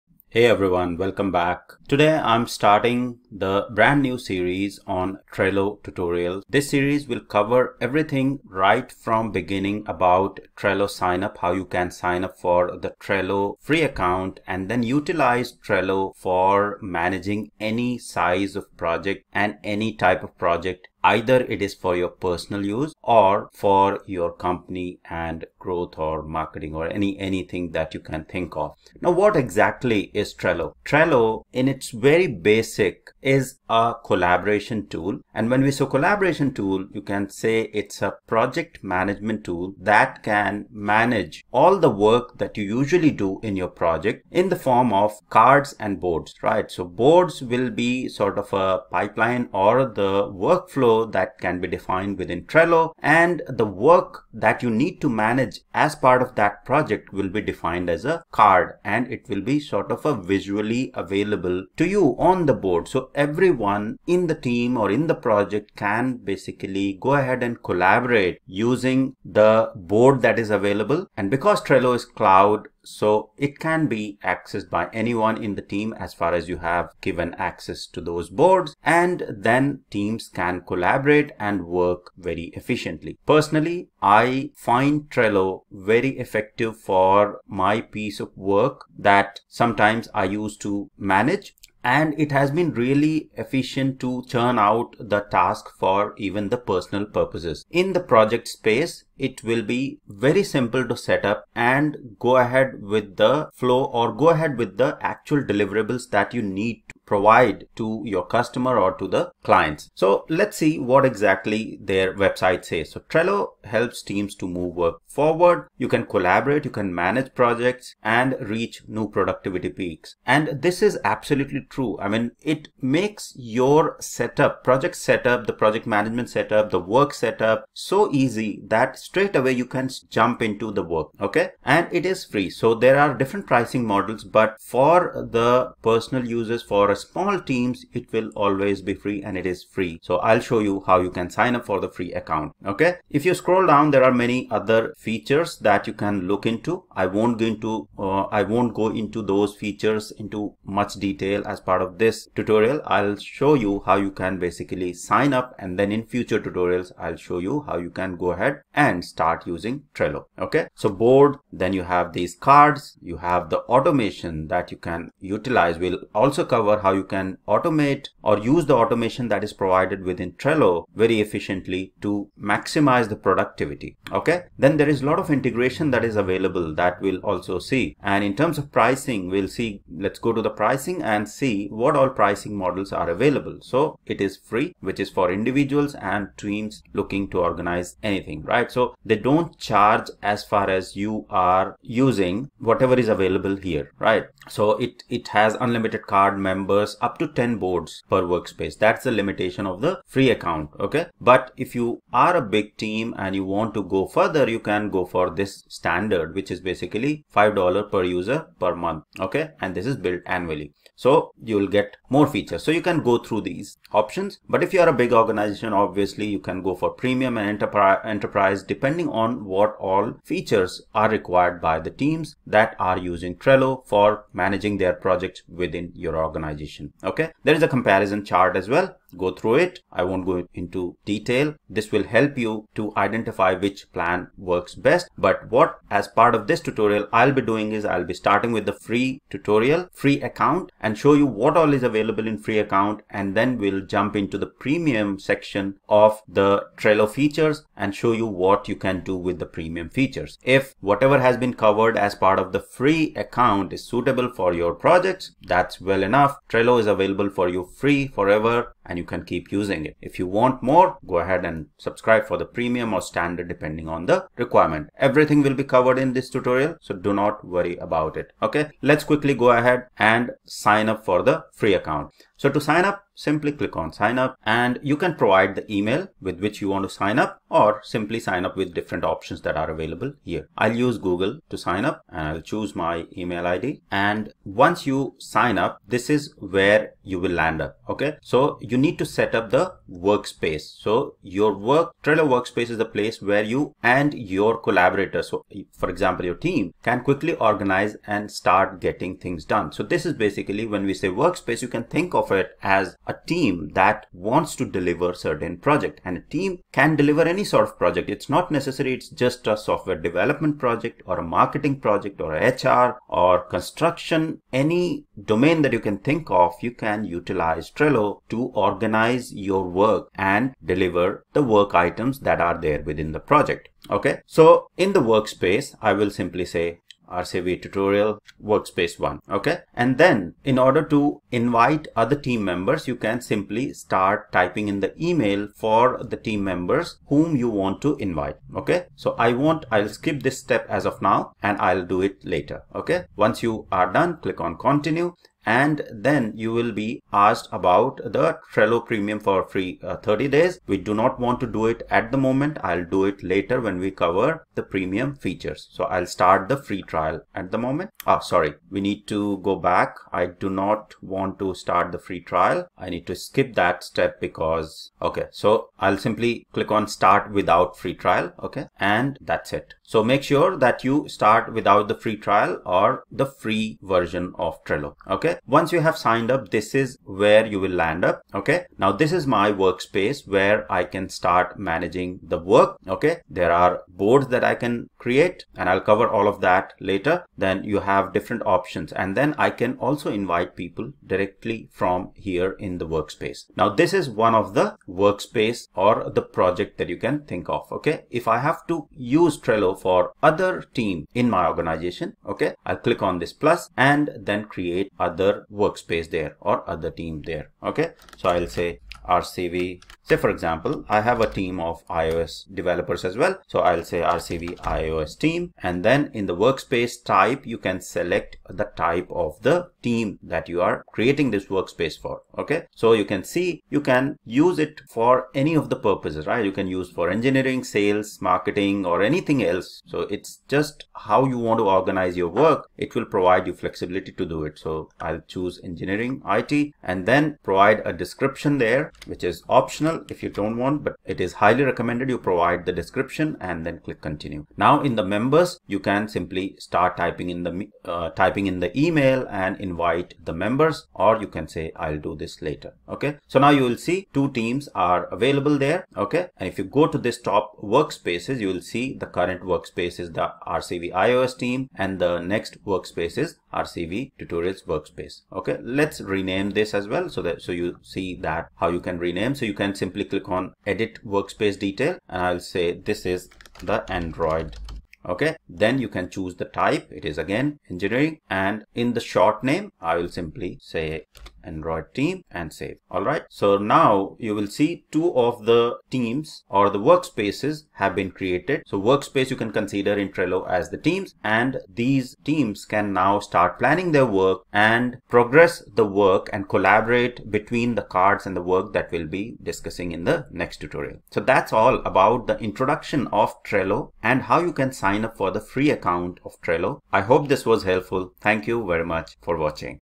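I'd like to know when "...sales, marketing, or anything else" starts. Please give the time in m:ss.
7:07.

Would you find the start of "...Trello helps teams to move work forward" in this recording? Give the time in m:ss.
1:53.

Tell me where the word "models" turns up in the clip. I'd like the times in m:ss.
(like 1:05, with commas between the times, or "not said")
2:13, 3:02.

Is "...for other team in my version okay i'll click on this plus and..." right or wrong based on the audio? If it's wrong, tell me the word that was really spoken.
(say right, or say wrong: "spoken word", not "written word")
wrong: "organization", not "version".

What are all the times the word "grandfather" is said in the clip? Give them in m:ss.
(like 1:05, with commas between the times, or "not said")
not said.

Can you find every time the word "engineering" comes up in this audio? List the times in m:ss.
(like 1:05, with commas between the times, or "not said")
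7:07, 7:15, 7:57.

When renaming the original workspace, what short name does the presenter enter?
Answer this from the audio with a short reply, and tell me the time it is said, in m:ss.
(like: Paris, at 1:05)
Android team, at 8:01.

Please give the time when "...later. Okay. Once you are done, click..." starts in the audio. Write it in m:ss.
5:42.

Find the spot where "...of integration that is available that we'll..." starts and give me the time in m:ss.
2:55.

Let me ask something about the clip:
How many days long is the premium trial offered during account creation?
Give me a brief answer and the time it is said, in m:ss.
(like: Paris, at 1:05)
30, at 5:49.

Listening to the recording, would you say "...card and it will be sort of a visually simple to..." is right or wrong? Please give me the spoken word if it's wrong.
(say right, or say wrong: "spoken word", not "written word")
wrong: "available", not "simple".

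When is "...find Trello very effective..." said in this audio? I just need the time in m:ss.
1:24.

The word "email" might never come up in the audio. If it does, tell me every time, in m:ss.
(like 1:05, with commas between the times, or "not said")
4:35, 4:43, 5:35, 7:28.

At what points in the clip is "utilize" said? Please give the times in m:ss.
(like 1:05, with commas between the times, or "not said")
0:14, 2:45, 5:17.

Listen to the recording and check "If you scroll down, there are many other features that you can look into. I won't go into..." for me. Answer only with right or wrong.
right.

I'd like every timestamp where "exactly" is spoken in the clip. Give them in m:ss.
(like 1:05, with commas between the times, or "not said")
0:29, 1:51.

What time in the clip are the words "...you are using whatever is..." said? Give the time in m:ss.
3:10.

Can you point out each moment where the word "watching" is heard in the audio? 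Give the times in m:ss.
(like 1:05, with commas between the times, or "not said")
8:29.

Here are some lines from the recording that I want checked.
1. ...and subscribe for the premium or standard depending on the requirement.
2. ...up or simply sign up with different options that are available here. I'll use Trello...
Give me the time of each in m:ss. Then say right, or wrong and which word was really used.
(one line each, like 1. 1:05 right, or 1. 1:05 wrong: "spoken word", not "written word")
1. 4:21 right
2. 4:37 wrong: "Google", not "Trello".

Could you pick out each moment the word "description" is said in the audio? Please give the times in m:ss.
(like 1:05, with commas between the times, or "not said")
7:17, 7:22.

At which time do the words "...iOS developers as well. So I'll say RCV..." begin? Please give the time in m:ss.
6:51.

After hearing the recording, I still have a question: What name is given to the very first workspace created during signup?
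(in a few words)
RCV tutorial workspace one.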